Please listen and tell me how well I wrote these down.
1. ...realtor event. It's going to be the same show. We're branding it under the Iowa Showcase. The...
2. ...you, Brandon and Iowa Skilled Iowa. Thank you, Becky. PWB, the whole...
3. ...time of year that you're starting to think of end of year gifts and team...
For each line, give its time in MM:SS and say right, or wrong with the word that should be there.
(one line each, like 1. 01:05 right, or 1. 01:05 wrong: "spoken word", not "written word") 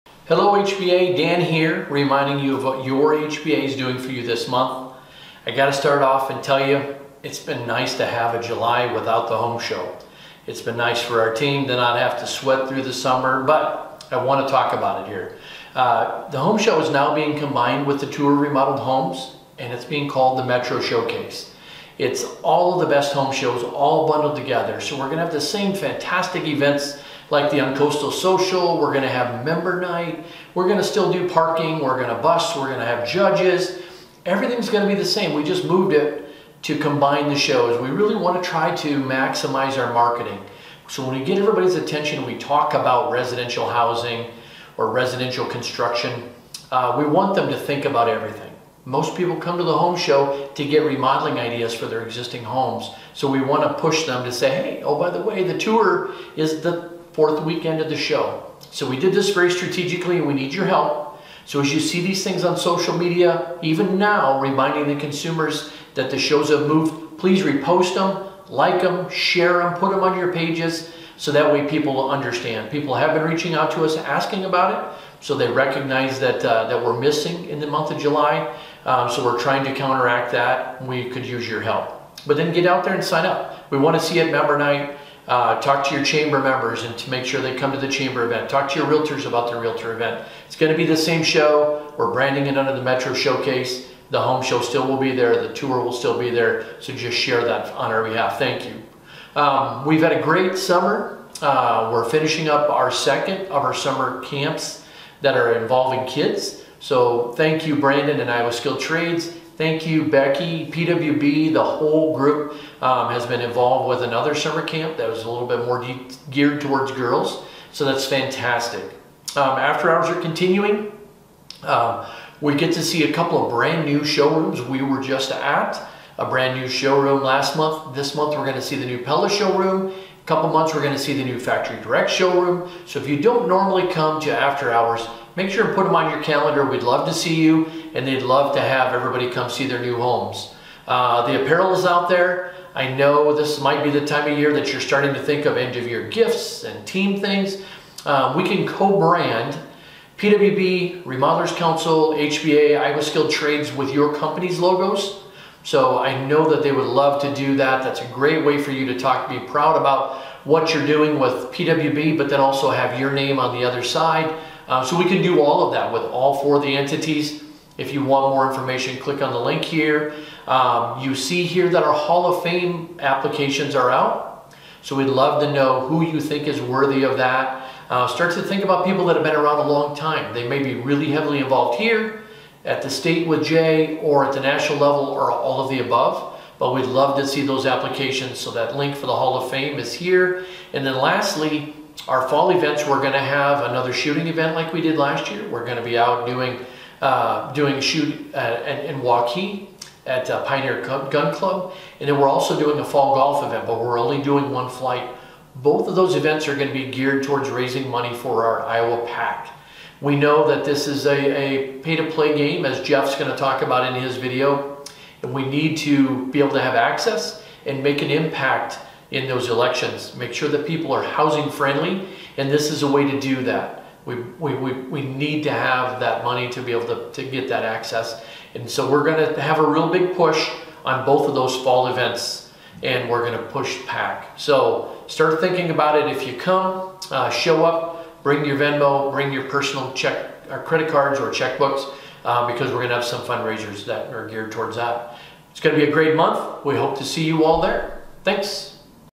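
1. 01:29 wrong: "Metro", not "Iowa"
2. 01:47 wrong: "Trades", not "Iowa"
3. 02:24 right.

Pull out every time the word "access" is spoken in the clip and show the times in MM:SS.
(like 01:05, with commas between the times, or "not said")
03:36, 03:47.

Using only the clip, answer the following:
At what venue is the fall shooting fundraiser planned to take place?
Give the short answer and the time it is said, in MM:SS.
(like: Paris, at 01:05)
Pioneer Gun Club, at 03:20.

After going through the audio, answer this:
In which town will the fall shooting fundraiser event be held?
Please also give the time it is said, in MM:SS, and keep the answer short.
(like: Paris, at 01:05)
Waukee, at 03:19.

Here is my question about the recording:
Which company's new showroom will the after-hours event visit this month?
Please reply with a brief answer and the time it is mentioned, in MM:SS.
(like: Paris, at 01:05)
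Pella, at 02:09.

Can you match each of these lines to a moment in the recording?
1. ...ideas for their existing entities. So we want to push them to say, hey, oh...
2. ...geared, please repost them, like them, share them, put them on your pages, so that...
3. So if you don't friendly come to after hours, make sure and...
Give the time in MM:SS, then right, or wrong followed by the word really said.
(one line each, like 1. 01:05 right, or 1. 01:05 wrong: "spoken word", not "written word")
1. 00:51 wrong: "homes", not "entities"
2. 01:06 wrong: "moved", not "geared"
3. 02:12 wrong: "normally", not "friendly".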